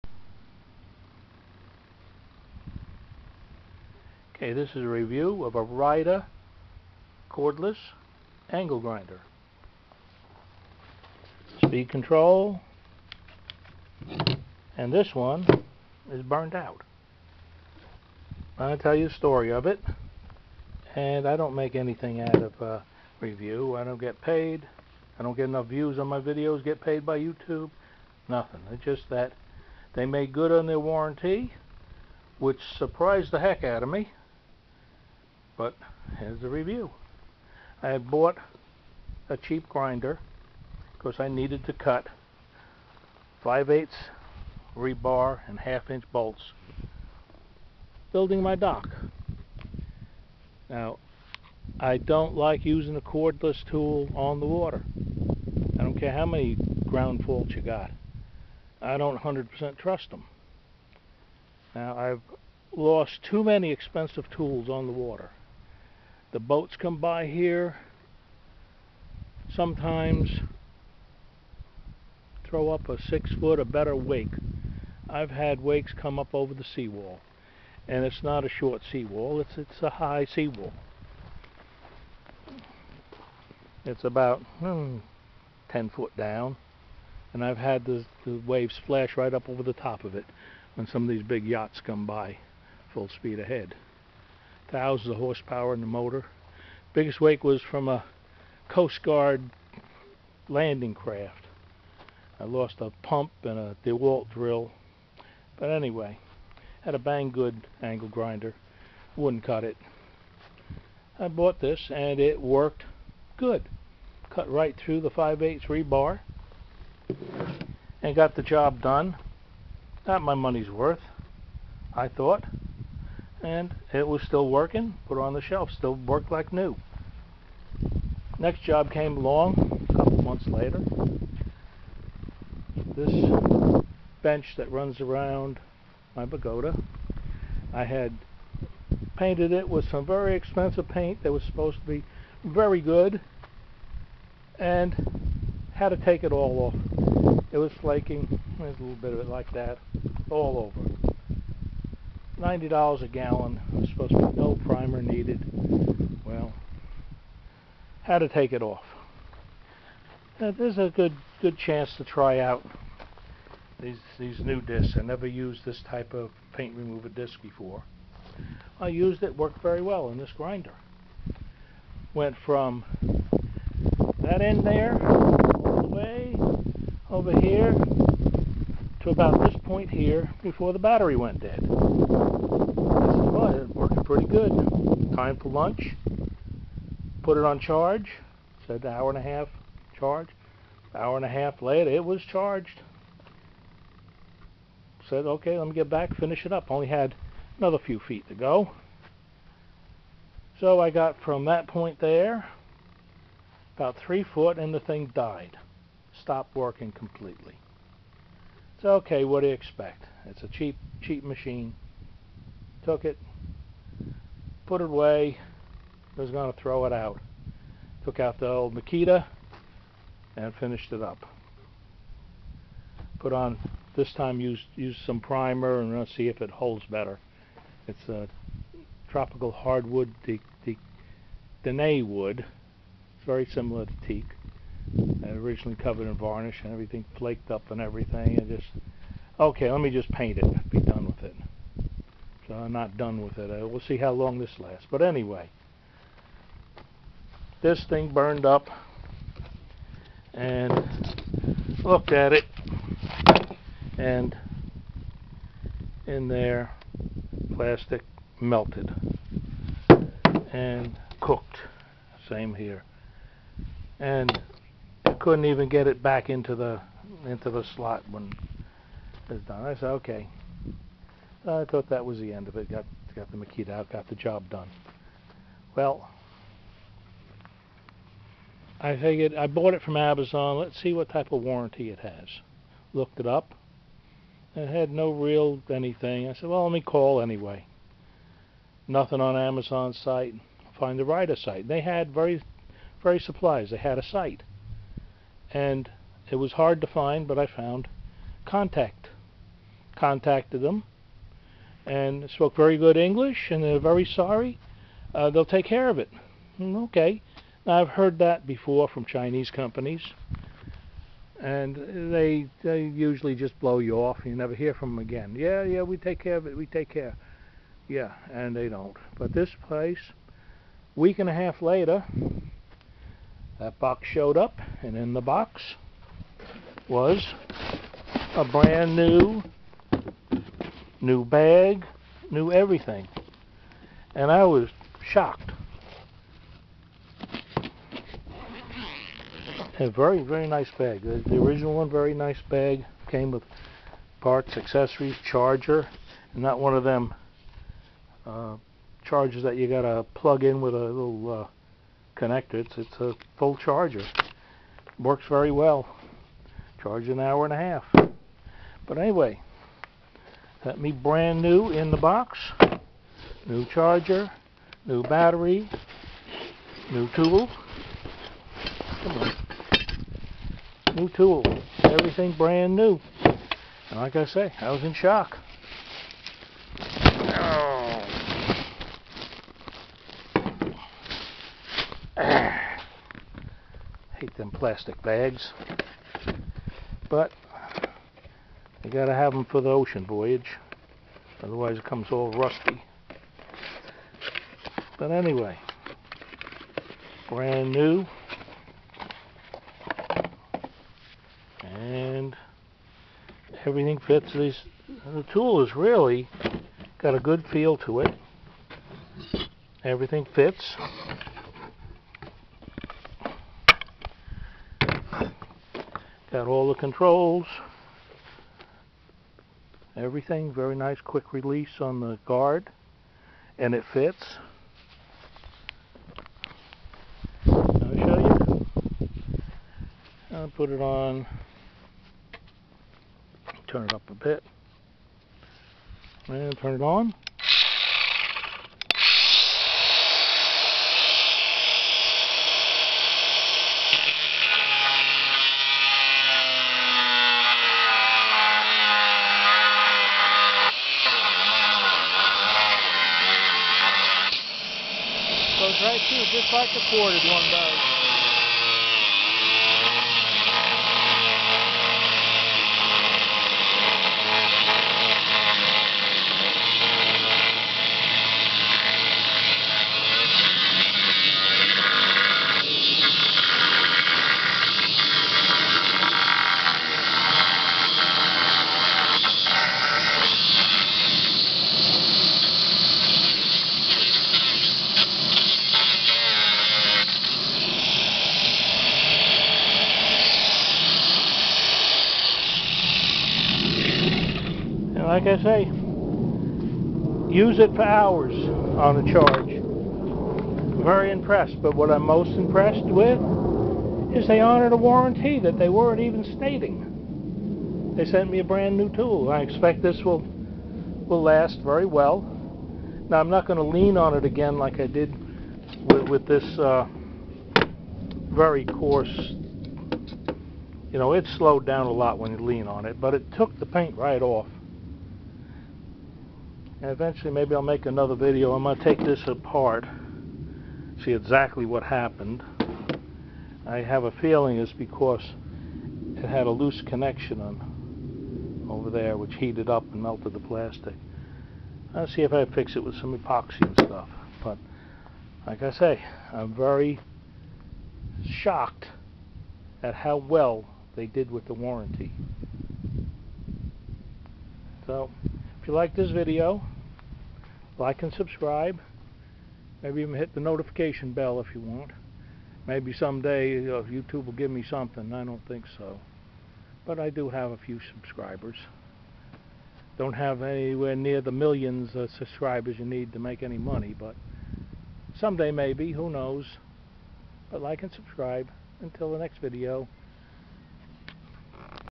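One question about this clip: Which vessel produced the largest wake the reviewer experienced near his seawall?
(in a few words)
Coast Guard landing craft.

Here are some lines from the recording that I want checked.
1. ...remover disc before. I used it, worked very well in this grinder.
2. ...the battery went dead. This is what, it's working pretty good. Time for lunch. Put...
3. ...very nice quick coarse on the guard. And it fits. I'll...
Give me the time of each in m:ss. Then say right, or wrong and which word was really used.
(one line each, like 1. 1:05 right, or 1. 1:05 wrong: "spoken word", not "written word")
1. 2:46 right
2. 3:00 right
3. 7:00 wrong: "release", not "coarse".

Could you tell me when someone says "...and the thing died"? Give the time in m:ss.
3:24.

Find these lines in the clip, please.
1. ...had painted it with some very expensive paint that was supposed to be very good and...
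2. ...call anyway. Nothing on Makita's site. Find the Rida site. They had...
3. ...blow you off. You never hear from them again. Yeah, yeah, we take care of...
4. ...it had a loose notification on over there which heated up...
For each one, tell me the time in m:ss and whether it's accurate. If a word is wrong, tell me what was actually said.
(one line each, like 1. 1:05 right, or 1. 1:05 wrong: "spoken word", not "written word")
1. 2:17 right
2. 4:46 wrong: "Amazon", not "Makita"
3. 5:13 right
4. 8:56 wrong: "connection", not "notification".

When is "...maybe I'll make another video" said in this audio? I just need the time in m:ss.
8:47.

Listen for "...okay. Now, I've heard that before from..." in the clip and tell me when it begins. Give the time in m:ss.
5:06.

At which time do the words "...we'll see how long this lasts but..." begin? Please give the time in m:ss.
4:03.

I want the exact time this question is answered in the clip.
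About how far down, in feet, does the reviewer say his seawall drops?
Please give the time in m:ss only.
1:25.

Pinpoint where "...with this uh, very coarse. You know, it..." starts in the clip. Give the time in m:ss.
8:36.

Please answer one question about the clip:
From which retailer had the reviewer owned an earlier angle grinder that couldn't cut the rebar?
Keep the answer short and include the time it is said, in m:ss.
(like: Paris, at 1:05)
Banggood, at 1:46.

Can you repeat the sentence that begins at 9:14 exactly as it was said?
So if you like this video, like and subscribe.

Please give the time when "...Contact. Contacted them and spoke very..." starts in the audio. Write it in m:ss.
4:58.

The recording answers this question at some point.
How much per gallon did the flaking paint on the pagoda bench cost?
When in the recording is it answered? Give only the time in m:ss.
2:32.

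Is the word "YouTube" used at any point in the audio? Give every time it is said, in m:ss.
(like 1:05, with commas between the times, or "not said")
0:27, 9:23.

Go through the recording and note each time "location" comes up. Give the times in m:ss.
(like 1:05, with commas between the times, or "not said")
not said.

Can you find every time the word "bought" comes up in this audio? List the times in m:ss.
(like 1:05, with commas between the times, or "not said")
0:37, 1:51, 4:39.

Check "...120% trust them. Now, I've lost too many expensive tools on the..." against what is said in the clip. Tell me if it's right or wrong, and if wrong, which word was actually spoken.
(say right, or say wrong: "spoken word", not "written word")
wrong: "100", not "120".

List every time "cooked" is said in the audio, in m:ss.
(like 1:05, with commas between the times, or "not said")
4:21.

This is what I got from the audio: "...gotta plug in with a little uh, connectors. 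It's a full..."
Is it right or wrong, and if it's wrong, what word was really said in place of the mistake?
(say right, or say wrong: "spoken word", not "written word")
right.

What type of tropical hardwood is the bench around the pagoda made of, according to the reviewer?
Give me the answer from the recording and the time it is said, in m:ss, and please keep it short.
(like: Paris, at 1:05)
Dene wood, at 3:51.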